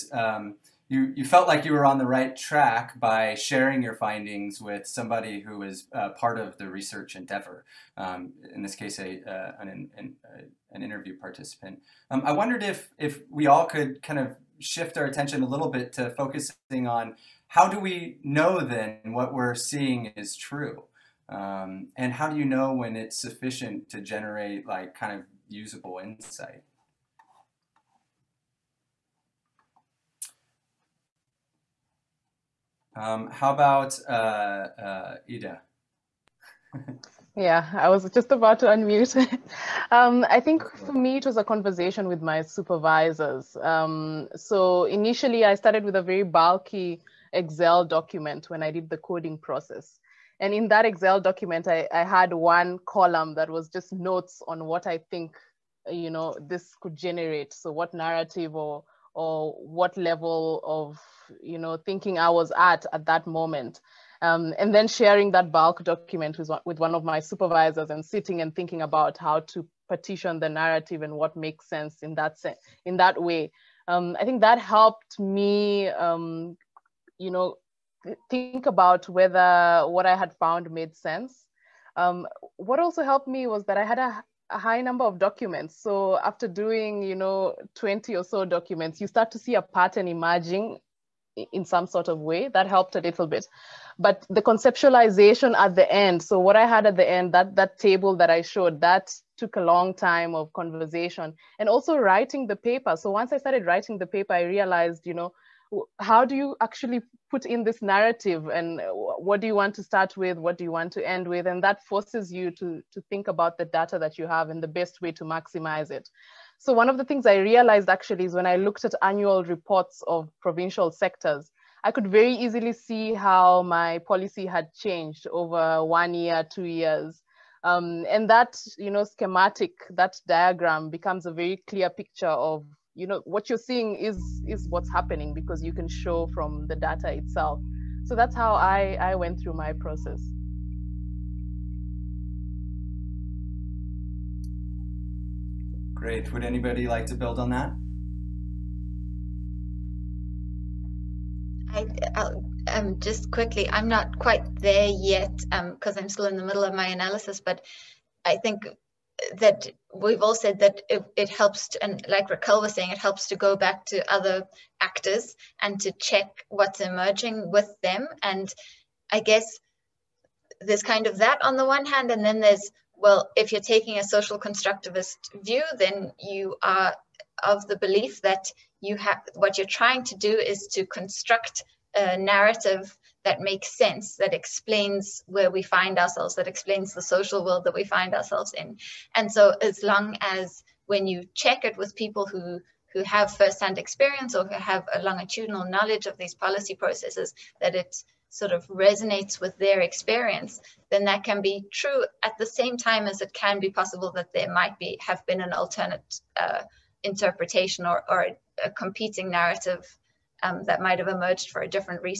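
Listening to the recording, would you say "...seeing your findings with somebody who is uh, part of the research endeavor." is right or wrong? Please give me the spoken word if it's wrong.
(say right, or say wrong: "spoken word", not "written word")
wrong: "sharing", not "seeing".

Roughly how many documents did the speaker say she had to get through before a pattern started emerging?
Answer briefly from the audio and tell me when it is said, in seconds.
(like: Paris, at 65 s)
20, at 87 s.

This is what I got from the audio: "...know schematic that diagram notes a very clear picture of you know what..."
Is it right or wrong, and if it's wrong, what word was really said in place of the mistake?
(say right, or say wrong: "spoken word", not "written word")
wrong: "becomes", not "notes".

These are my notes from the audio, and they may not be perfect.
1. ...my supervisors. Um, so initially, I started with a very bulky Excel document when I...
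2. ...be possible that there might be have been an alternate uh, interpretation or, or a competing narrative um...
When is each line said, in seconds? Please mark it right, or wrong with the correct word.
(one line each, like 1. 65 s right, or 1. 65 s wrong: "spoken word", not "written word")
1. 42 s right
2. 203 s right.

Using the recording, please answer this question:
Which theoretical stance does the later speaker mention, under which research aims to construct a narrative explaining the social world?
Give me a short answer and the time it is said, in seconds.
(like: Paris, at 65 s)
Social constructivist, at 174 s.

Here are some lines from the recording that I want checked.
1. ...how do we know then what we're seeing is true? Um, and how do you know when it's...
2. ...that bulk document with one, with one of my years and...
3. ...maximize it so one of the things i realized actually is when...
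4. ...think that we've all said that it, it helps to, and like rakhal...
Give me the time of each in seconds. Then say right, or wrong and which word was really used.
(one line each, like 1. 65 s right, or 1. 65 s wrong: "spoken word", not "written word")
1. 17 s right
2. 65 s wrong: "supervisors", not "years"
3. 115 s right
4. 158 s right.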